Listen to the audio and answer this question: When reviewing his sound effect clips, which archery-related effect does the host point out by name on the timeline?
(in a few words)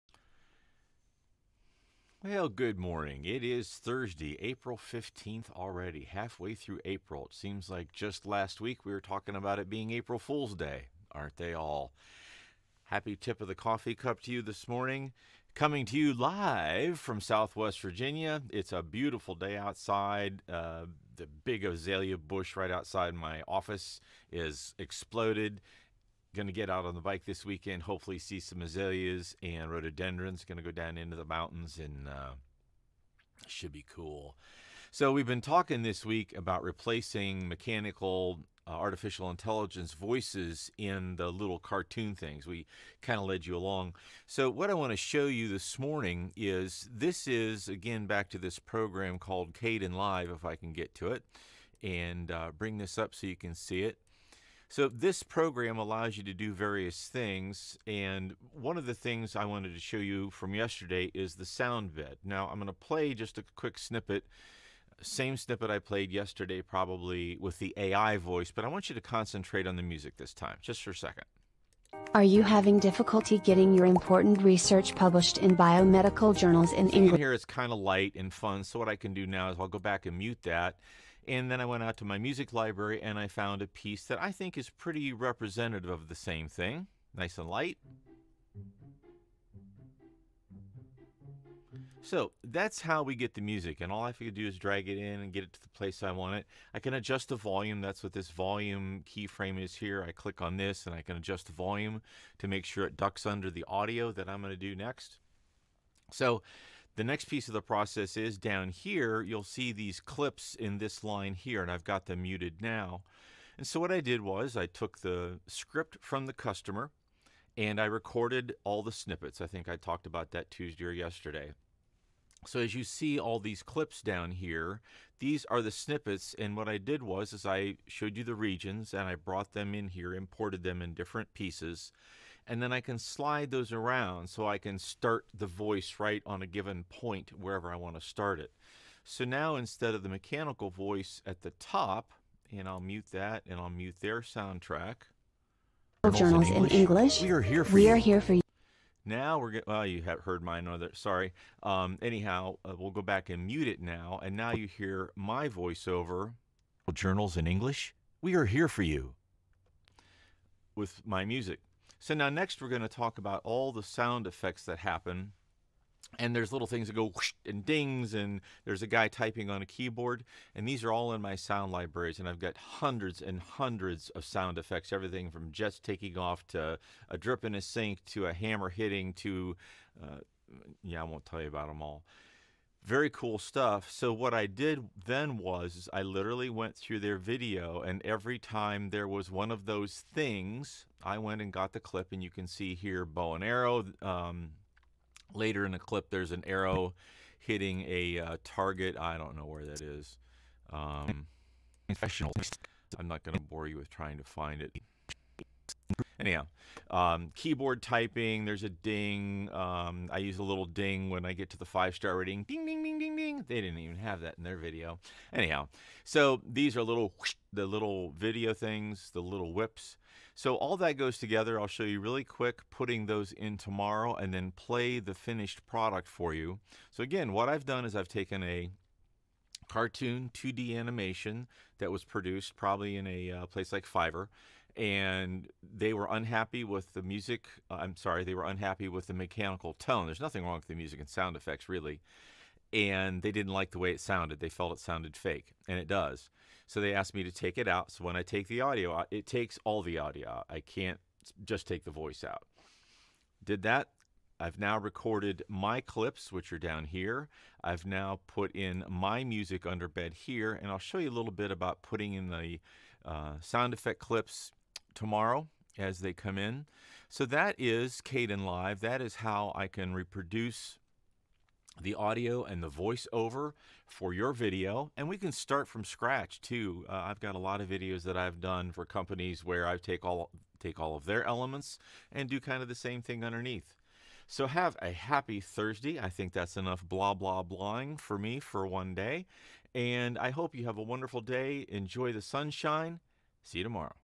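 bow and arrow.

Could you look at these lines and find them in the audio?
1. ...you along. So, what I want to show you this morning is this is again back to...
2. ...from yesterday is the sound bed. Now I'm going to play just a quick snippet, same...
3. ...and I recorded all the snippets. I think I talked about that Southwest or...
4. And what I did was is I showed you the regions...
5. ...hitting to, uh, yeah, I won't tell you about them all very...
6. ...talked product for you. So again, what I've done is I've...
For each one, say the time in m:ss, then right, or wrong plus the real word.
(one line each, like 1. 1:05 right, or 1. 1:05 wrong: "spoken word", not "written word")
1. 0:43 right
2. 1:00 right
3. 1:57 wrong: "Tuesday", not "Southwest"
4. 2:06 right
5. 2:58 right
6. 3:45 wrong: "finished", not "talked".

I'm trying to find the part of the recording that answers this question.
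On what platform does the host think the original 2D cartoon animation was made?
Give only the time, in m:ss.
3:53.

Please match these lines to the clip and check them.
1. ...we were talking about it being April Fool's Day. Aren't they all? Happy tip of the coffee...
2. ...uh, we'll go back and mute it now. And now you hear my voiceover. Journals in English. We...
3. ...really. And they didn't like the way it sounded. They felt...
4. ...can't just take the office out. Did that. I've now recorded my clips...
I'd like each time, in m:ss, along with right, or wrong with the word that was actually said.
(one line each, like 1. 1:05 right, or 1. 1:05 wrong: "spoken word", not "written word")
1. 0:08 right
2. 2:32 right
3. 4:01 right
4. 4:10 wrong: "voice", not "office".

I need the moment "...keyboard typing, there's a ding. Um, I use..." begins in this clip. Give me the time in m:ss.
3:27.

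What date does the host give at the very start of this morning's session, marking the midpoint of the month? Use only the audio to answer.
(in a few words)
April 15th.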